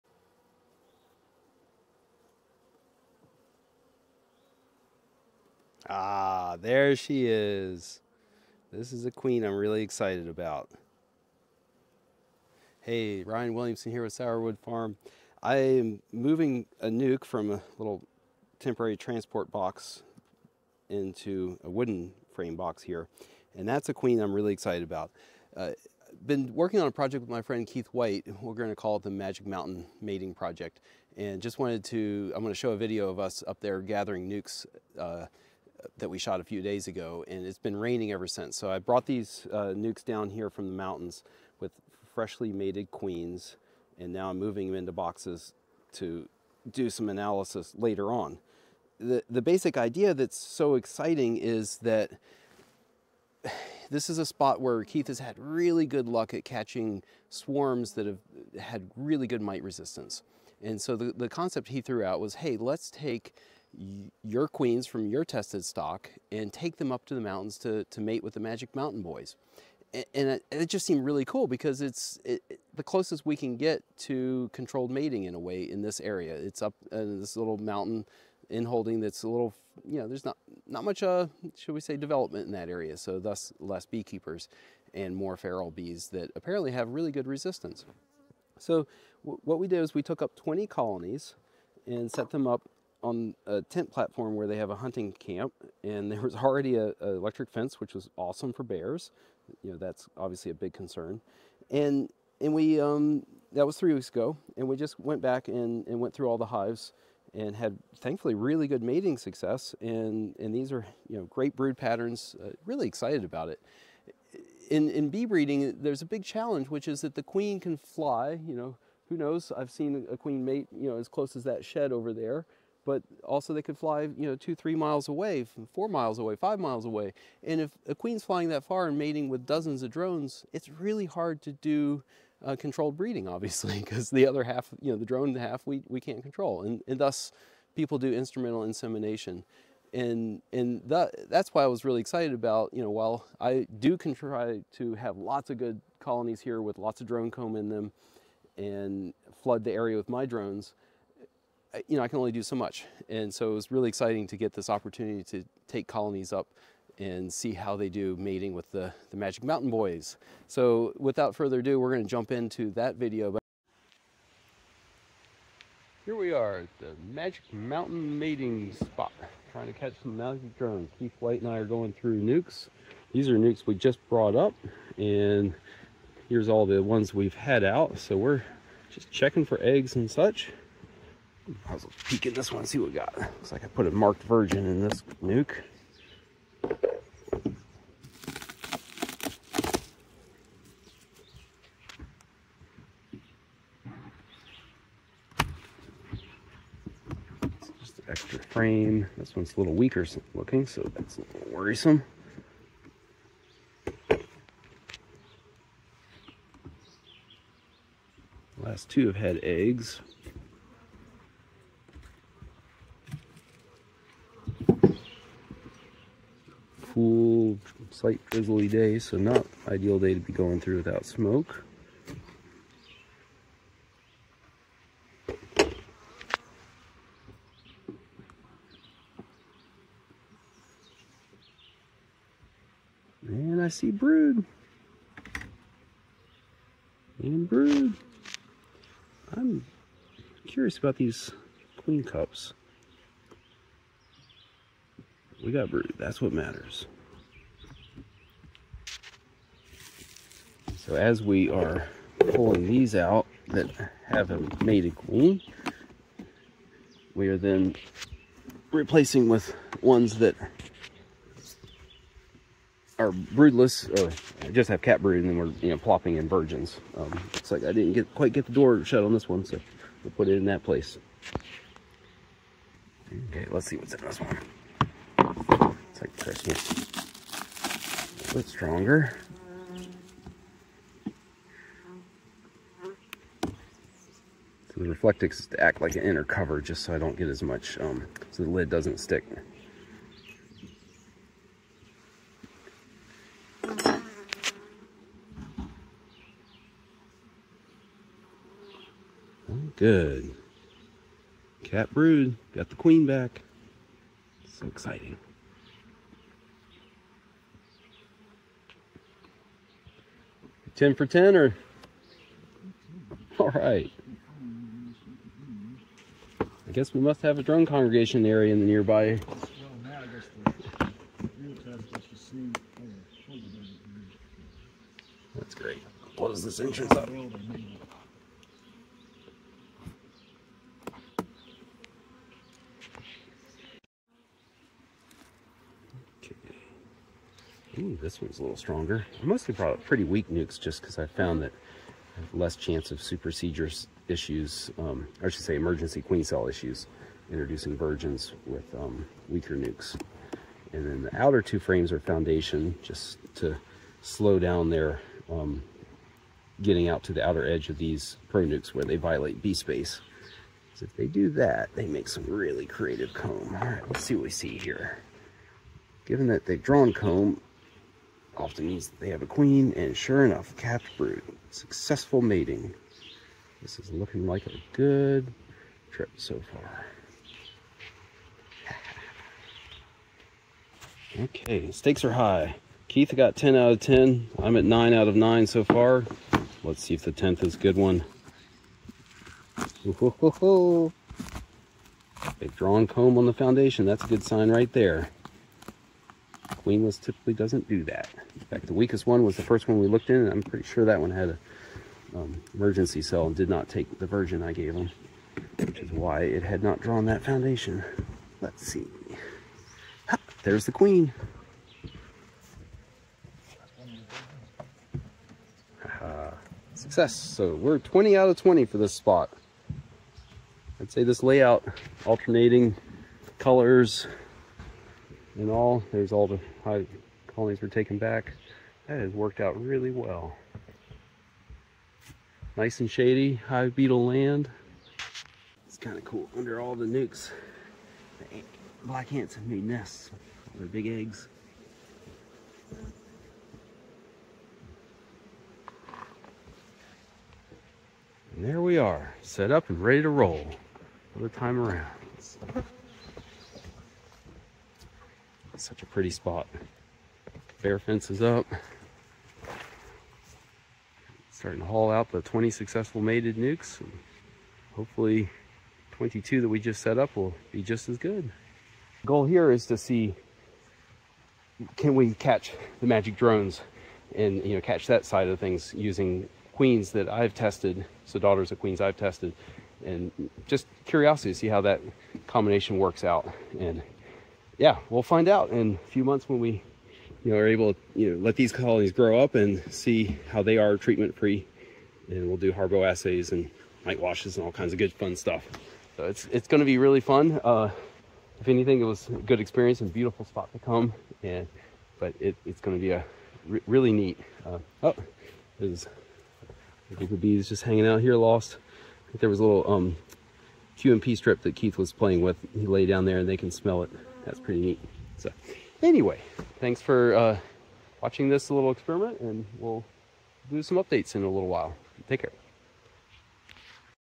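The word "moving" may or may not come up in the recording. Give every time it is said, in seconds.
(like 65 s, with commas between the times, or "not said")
16 s, 44 s.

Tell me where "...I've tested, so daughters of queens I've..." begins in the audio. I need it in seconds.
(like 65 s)
477 s.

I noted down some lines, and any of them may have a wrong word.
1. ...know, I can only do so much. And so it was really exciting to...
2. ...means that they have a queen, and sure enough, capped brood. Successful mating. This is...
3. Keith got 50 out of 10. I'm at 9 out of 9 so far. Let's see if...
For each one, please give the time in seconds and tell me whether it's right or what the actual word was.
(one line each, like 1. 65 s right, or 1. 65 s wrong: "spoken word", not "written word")
1. 151 s right
2. 368 s right
3. 382 s wrong: "10", not "50".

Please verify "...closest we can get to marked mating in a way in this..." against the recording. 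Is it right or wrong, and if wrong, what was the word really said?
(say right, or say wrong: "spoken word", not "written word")
wrong: "controlled", not "marked".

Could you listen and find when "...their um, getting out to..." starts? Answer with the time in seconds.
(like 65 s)
354 s.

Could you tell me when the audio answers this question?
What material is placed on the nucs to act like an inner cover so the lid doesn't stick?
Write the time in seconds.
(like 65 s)
284 s.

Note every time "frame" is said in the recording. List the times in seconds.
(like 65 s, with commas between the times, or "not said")
22 s, 198 s, 351 s.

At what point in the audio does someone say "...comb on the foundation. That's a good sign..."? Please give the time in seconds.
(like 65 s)
392 s.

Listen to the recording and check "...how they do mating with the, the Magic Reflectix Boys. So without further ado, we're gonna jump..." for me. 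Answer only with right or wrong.
wrong.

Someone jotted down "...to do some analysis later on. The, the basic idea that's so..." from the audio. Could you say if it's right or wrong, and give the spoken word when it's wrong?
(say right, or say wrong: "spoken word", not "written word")
right.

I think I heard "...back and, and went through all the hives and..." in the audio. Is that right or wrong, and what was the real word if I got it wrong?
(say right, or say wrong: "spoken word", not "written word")
right.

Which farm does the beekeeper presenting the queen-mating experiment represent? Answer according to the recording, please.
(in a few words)
Sourwood Farm.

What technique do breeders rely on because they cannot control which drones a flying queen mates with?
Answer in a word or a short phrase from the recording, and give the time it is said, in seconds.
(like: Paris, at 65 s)
instrumental insemination, at 138 s.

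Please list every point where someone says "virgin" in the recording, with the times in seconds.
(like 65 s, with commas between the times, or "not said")
184 s, 266 s, 347 s, 404 s.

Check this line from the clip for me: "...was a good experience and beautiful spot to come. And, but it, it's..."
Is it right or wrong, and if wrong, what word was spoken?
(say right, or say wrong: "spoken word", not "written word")
right.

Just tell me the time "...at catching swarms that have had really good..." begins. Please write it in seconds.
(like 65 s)
56 s.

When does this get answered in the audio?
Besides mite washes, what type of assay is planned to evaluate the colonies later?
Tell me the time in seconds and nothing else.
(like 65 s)
492 s.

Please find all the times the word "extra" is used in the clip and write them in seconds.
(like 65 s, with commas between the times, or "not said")
198 s.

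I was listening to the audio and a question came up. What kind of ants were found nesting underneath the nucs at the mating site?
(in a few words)
black ants.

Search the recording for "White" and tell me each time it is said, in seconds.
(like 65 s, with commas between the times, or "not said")
27 s, 171 s.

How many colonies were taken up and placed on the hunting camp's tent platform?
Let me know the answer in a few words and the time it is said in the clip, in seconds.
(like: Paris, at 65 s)
20, at 90 s.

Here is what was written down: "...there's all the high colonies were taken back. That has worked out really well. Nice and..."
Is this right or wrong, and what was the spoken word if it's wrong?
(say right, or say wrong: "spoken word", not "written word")
right.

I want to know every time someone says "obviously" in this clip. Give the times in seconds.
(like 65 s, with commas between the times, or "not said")
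100 s, 133 s.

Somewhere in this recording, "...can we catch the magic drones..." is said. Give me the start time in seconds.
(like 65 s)
471 s.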